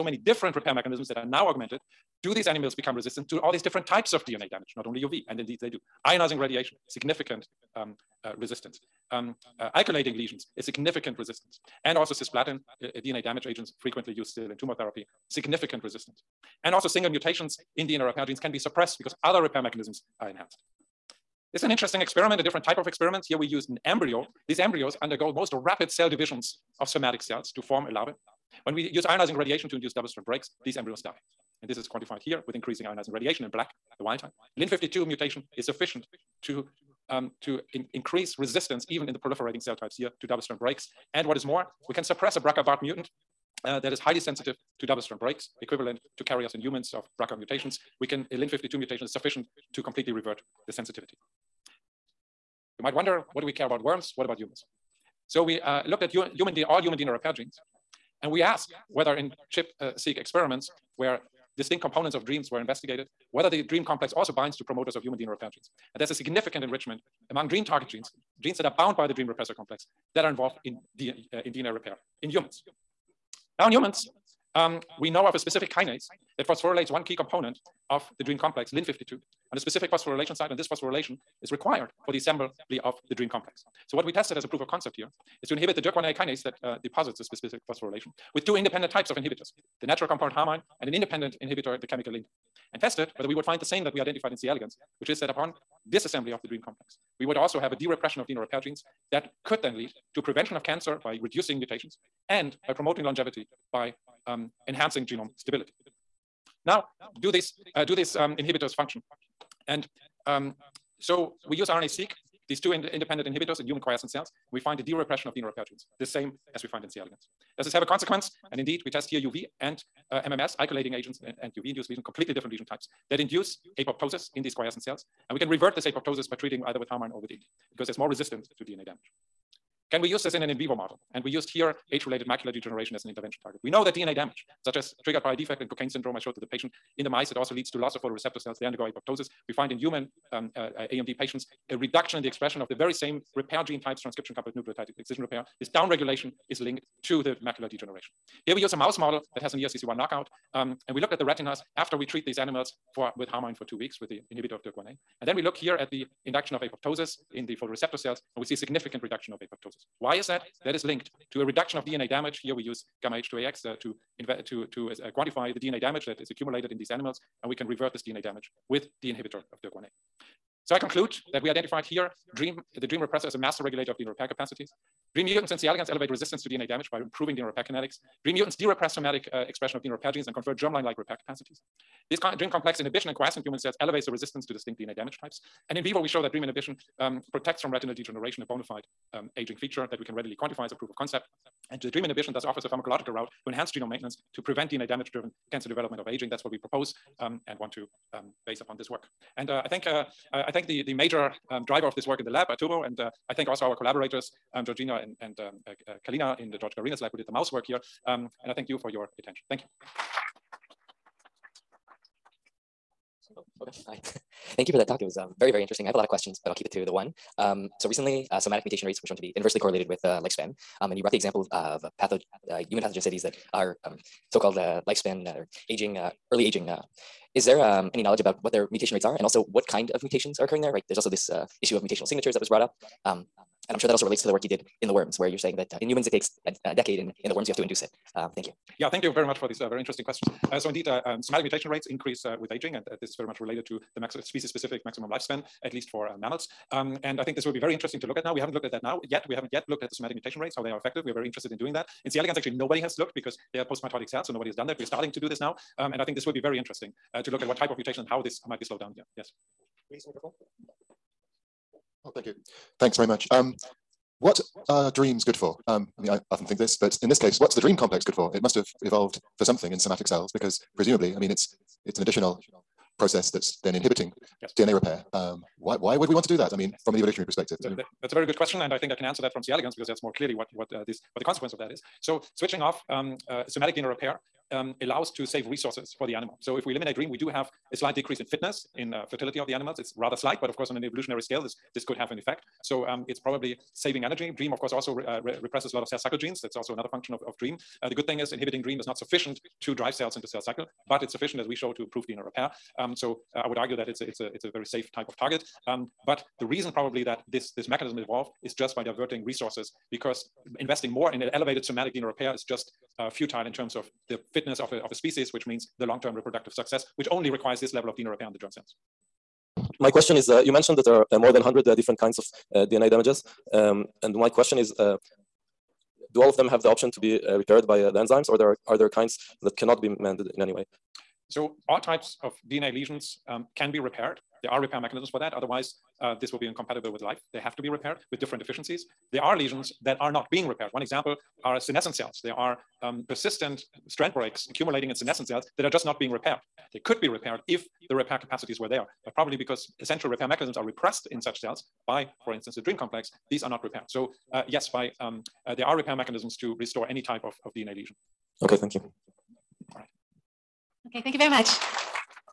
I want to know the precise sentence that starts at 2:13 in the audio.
We know that DNA damage such as triggered by a defect in Cockayne syndrome I showed to the patient.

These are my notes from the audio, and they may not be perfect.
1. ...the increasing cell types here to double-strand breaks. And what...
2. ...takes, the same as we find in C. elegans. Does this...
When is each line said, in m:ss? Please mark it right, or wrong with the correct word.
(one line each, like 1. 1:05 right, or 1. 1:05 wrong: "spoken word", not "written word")
1. 0:39 wrong: "proliferating", not "increasing"
2. 1:55 wrong: "genes", not "takes".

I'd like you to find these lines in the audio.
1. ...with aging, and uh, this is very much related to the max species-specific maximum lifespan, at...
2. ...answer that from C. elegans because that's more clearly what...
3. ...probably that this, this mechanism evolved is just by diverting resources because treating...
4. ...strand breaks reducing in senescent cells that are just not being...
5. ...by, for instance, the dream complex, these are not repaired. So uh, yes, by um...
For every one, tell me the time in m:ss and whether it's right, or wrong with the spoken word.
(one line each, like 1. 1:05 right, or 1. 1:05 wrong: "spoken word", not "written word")
1. 4:02 right
2. 4:39 right
3. 5:06 wrong: "investing", not "treating"
4. 5:43 wrong: "accumulating", not "reducing"
5. 5:51 right.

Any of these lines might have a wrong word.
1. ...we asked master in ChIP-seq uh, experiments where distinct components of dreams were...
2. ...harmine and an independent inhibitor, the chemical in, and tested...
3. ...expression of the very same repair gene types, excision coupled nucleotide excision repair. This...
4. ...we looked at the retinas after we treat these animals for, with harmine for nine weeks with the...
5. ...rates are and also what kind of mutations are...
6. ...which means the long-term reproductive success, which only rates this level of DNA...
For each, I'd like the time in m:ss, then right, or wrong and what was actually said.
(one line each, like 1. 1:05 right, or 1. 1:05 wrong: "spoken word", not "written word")
1. 0:58 wrong: "whether", not "master"
2. 1:30 right
3. 2:22 wrong: "transcription", not "excision"
4. 2:30 wrong: "two", not "nine"
5. 3:48 right
6. 5:15 wrong: "requires", not "rates".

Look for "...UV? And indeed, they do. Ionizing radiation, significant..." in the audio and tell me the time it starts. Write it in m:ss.
0:05.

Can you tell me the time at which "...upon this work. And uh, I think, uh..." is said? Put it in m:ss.
3:18.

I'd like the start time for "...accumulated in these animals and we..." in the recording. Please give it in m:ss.
2:46.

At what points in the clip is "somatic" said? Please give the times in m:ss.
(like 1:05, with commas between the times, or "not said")
0:26, 2:58, 3:38, 4:01, 4:09, 4:29, 4:43, 5:11.